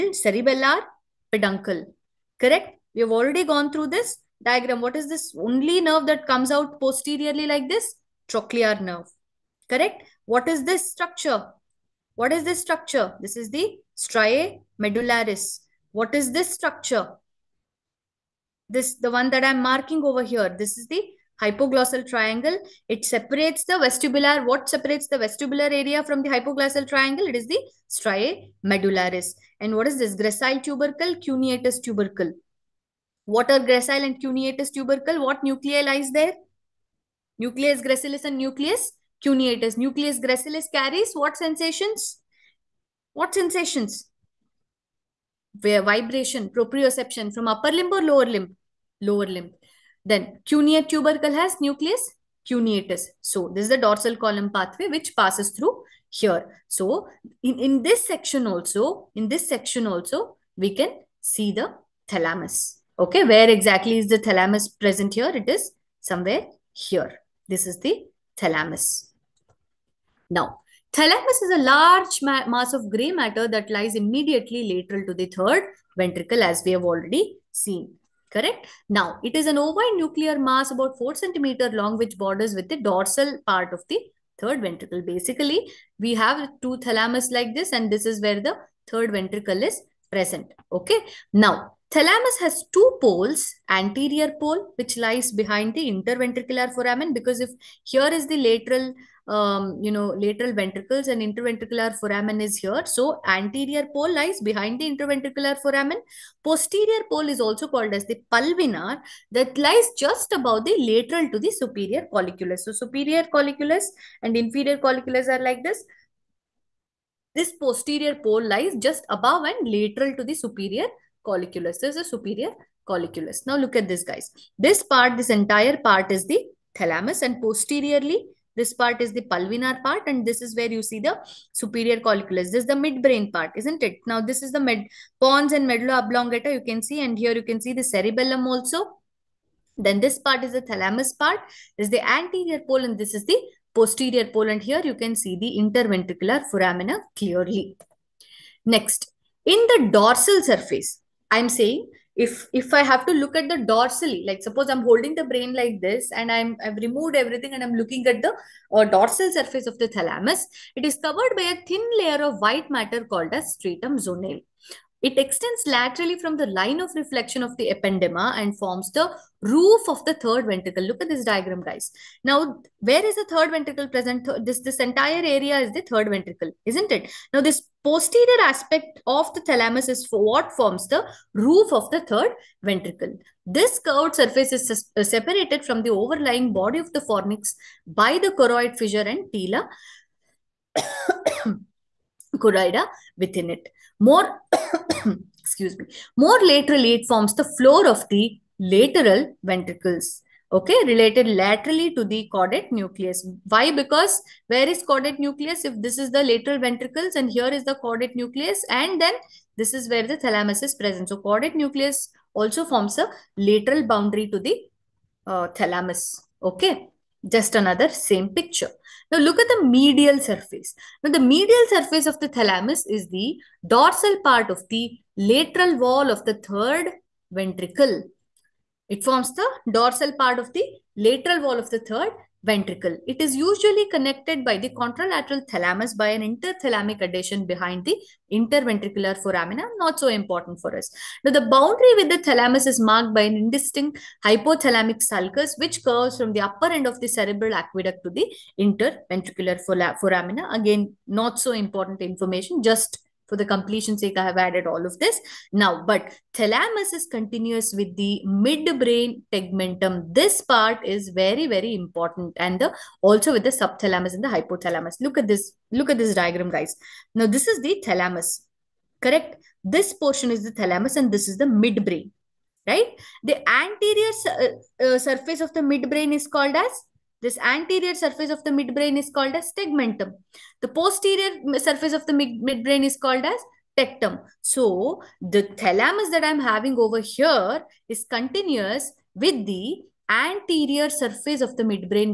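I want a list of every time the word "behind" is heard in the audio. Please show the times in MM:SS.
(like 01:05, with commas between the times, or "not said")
01:35, 01:44, 03:57.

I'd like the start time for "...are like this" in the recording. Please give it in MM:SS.
01:55.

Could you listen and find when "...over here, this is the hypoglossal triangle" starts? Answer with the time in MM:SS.
00:20.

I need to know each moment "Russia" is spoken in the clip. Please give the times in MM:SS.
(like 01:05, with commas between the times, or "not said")
not said.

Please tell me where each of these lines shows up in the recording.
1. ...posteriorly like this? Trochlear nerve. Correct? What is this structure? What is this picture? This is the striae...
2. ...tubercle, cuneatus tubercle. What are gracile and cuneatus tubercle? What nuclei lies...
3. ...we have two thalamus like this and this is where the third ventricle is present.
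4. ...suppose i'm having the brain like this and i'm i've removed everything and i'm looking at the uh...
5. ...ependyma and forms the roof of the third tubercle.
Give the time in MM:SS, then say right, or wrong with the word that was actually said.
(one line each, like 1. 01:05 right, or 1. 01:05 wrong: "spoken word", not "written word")
1. 00:06 wrong: "structure", not "picture"
2. 00:30 right
3. 01:25 right
4. 02:34 wrong: "holding", not "having"
5. 02:47 wrong: "ventricle", not "tubercle".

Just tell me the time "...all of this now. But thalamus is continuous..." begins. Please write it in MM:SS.
04:14.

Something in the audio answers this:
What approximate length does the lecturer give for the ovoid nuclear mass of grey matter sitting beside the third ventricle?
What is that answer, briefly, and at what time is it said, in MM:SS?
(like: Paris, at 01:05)
4 centimeters, at 01:20.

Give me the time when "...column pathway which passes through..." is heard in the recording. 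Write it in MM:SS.
00:54.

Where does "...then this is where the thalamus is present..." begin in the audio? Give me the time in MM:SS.
03:28.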